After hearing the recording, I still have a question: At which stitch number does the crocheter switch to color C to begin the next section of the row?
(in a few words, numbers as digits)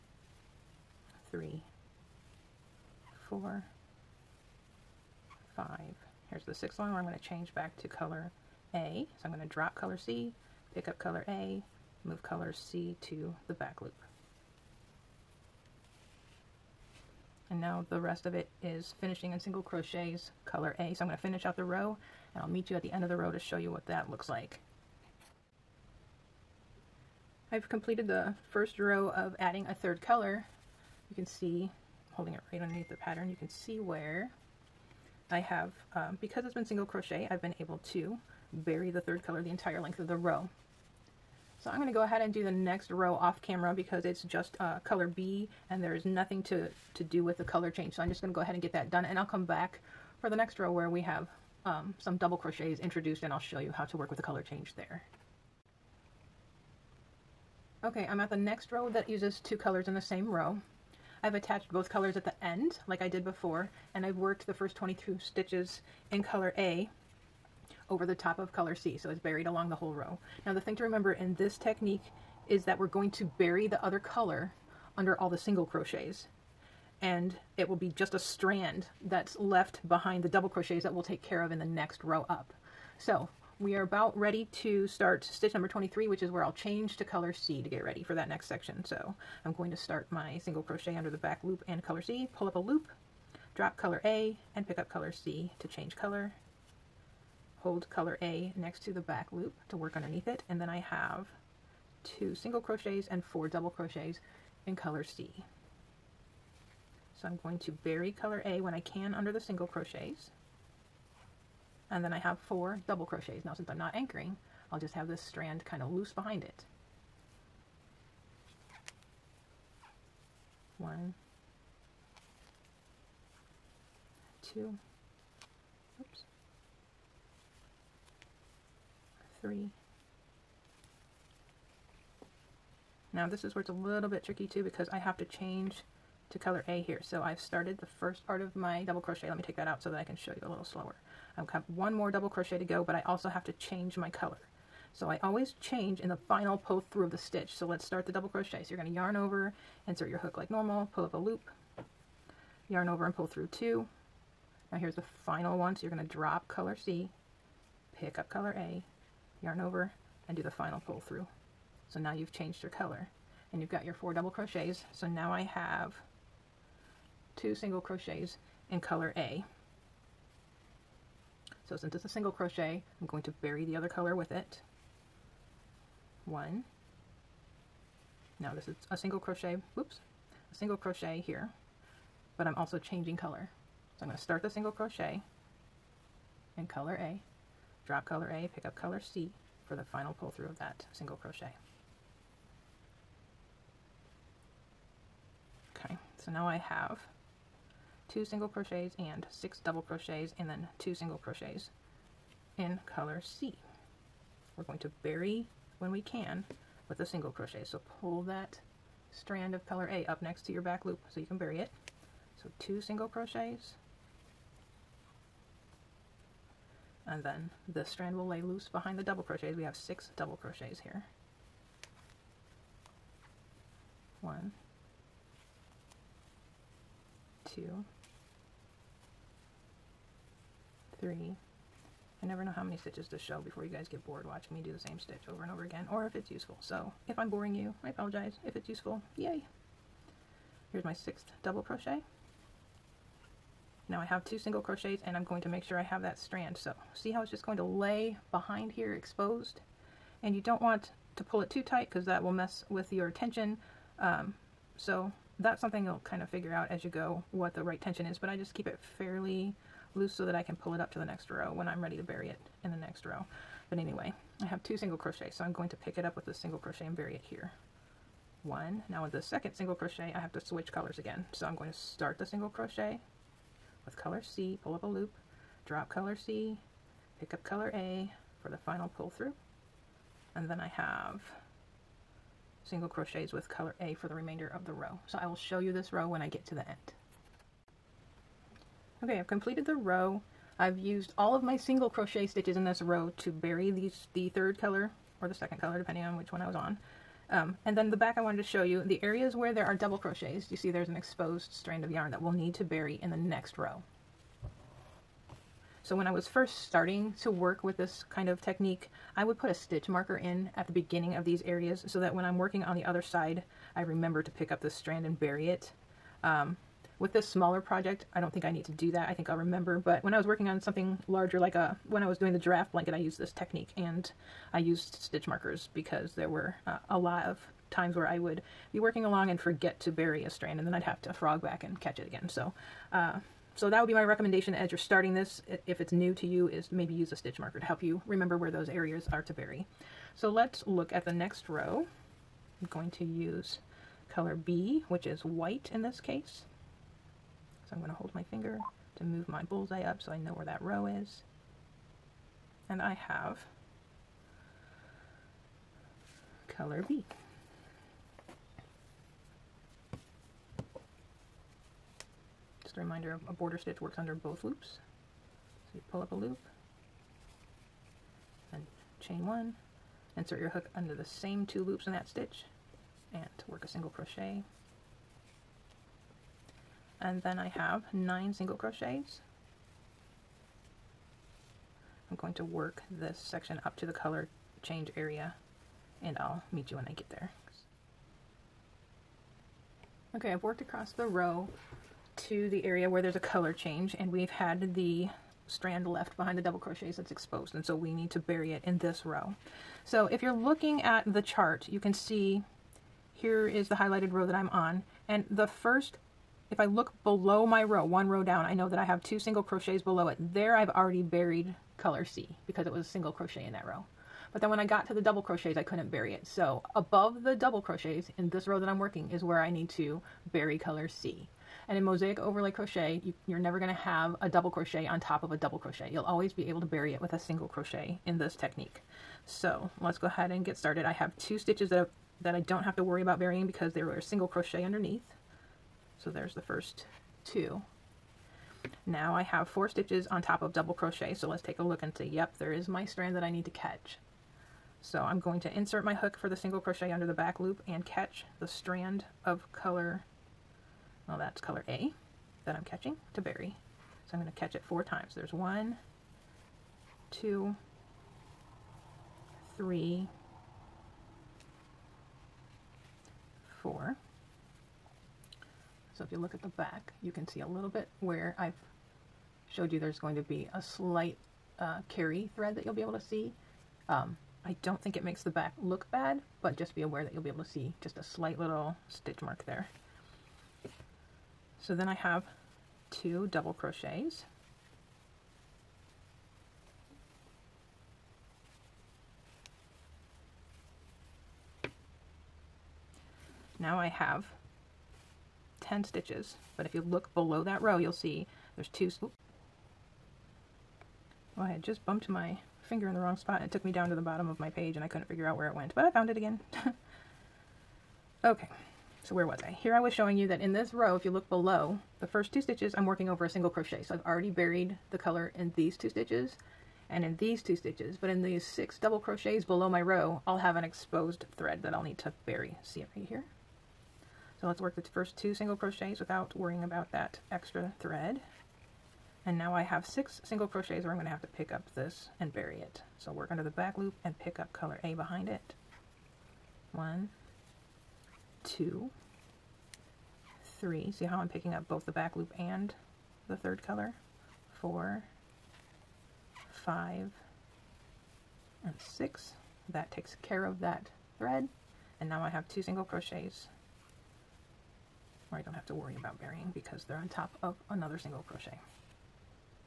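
23.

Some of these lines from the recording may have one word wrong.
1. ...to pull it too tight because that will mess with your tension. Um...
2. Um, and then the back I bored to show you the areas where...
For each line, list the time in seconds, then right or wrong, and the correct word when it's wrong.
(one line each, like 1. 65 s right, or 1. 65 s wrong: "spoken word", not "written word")
1. 251 s right
2. 297 s wrong: "wanted", not "bored".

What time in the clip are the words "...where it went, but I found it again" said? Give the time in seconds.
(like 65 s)
505 s.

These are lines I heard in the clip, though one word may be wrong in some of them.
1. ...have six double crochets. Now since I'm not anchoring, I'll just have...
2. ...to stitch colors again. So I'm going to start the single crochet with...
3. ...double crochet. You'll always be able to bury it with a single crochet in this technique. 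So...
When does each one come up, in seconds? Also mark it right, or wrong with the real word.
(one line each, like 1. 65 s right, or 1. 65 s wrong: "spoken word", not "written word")
1. 112 s wrong: "four", not "six"
2. 270 s wrong: "switch", not "stitch"
3. 425 s right.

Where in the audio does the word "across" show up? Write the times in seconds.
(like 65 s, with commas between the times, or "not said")
390 s.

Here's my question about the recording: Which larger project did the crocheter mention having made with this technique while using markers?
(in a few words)
giraffe blanket.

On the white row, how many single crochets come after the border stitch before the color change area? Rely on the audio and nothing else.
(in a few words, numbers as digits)
9.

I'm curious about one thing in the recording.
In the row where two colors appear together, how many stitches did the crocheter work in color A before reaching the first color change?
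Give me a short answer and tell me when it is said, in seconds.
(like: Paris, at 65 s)
22, at 64 s.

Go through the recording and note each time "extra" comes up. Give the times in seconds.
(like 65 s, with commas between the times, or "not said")
527 s.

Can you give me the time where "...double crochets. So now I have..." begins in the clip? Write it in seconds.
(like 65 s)
164 s.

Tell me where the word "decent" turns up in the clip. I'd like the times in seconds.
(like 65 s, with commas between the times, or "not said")
not said.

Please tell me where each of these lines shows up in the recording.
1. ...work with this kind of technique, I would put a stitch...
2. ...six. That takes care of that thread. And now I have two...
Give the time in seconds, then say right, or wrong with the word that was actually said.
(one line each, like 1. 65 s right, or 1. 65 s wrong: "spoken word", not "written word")
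1. 307 s right
2. 548 s right.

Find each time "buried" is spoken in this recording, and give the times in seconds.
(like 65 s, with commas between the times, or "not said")
69 s, 411 s, 514 s.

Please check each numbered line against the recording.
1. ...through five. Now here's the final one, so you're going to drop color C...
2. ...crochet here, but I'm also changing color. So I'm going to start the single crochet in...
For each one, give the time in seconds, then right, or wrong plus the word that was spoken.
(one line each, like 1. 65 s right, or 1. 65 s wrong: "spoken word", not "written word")
1. 153 s wrong: "two", not "five"
2. 180 s right.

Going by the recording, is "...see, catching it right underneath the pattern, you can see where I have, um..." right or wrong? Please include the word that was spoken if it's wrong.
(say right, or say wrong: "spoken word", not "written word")
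wrong: "holding", not "catching".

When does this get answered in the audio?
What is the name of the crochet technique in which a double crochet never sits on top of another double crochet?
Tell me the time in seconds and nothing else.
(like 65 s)
421 s.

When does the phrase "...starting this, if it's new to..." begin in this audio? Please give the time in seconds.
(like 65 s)
334 s.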